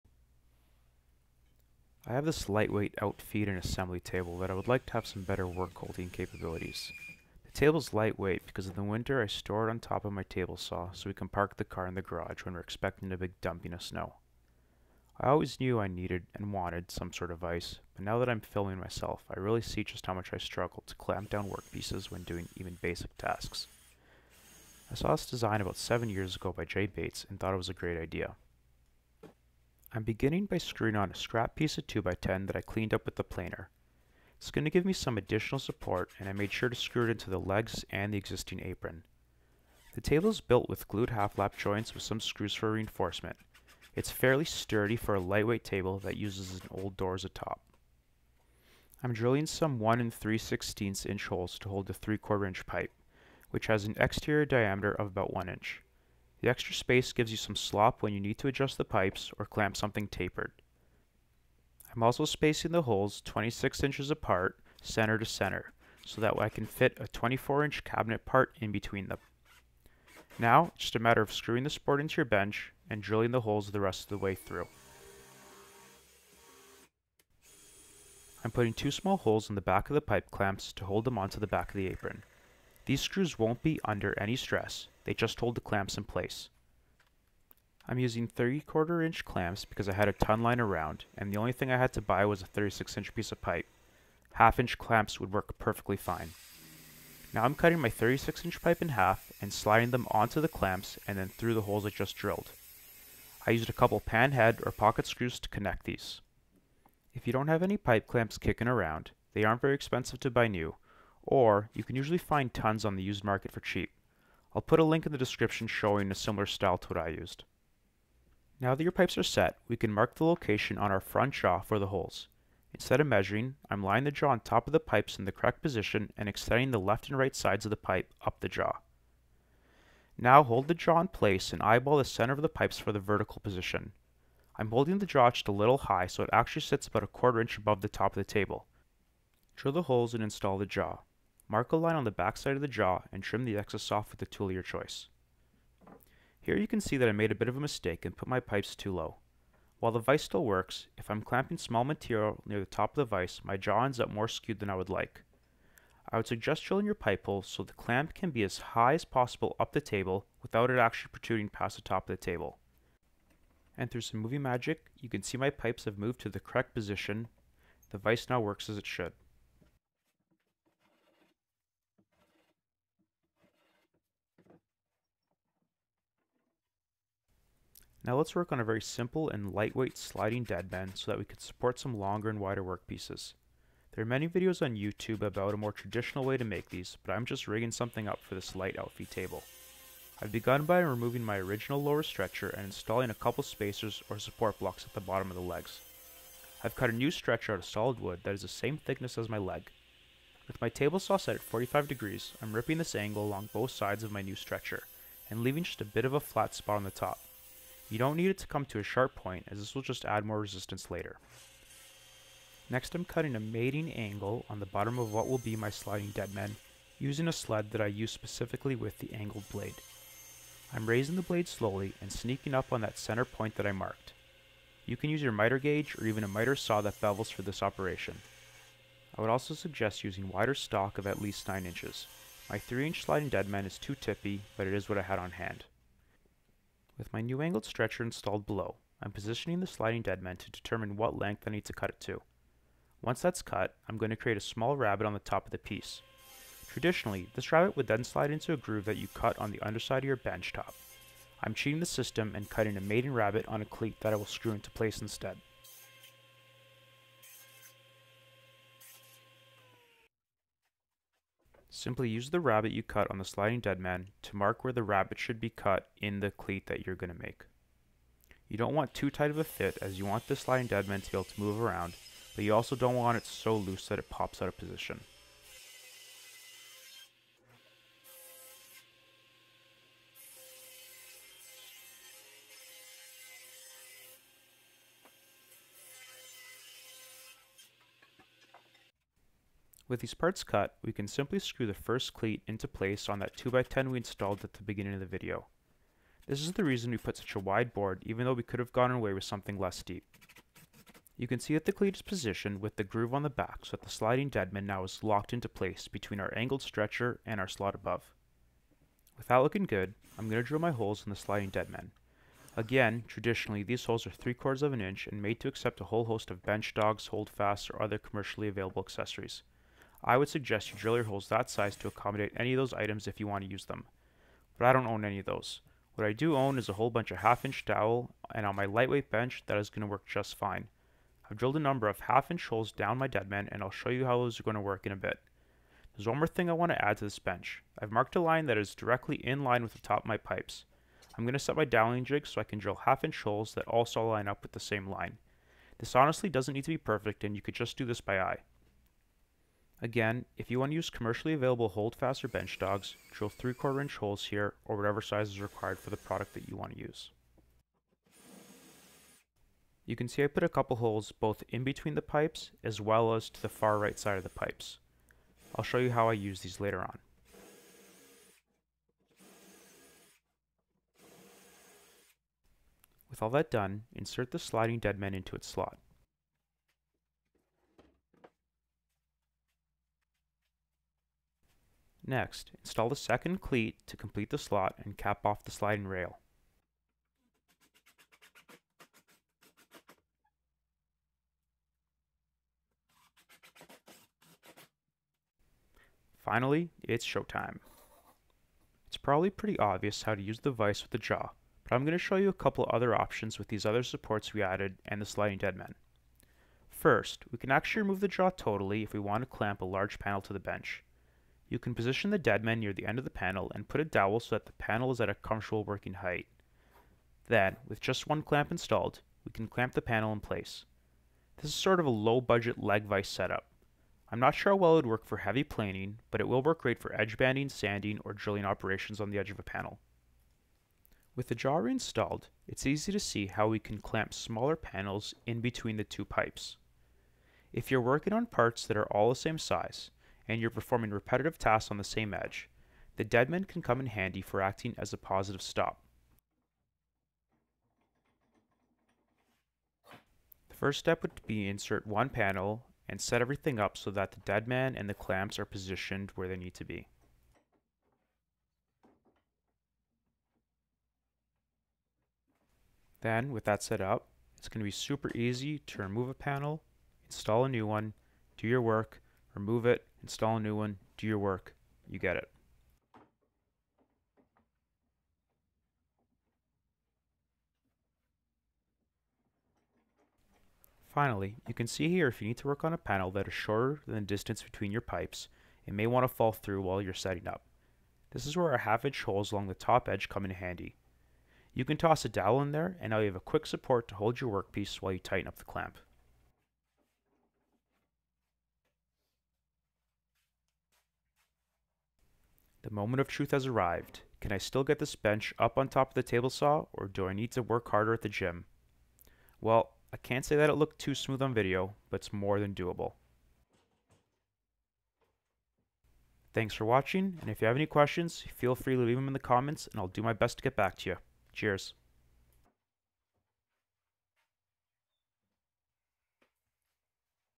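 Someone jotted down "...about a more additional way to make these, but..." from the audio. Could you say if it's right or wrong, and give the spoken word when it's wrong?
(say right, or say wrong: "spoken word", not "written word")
wrong: "traditional", not "additional".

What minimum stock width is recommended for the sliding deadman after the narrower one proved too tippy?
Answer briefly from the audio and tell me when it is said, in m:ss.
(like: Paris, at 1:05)
9 inches, at 3:51.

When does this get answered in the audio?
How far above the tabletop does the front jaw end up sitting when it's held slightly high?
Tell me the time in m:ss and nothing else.
2:17.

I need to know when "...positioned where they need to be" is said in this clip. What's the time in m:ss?
7:35.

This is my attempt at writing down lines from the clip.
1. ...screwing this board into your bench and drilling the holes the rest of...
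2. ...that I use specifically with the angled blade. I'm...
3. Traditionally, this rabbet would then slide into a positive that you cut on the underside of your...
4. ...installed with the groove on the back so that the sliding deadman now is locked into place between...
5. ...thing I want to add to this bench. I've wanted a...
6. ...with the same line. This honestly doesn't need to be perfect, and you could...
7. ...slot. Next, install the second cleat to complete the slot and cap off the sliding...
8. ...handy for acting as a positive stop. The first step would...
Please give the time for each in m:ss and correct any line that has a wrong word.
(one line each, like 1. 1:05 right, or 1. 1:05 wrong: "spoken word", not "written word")
1. 1:11 right
2. 3:37 right
3. 4:06 wrong: "groove", not "positive"
4. 5:02 wrong: "positioned", not "installed"
5. 5:36 wrong: "marked", not "wanted"
6. 5:44 right
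7. 6:15 right
8. 7:23 right.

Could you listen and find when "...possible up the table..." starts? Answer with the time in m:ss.
2:39.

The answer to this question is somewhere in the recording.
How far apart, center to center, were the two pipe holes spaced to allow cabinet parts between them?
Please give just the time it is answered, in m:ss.
1:03.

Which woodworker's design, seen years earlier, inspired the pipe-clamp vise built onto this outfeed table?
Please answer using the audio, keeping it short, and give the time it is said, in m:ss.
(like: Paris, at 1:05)
Jay Bates, at 0:26.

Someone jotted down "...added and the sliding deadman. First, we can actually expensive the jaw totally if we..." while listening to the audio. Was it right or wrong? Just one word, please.
wrong.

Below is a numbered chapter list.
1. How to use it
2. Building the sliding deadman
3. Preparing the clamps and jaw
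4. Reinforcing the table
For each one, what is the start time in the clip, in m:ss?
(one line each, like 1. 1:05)
1. 6:35
2. 2:50
3. 1:20
4. 0:30.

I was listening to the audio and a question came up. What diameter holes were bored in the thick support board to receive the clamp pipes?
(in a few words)
1 3/16 inch.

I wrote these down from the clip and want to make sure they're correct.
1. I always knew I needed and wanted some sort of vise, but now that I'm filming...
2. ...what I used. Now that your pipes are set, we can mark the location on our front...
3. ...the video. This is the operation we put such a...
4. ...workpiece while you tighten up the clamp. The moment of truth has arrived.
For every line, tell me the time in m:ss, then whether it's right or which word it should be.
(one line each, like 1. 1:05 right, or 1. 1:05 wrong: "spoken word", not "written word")
1. 0:15 right
2. 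1:56 right
3. 4:55 wrong: "reason", not "operation"
4. 8:14 right.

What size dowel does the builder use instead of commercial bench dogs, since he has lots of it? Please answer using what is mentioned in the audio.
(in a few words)
1/2 inch.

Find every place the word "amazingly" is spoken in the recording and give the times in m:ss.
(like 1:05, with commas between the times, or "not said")
not said.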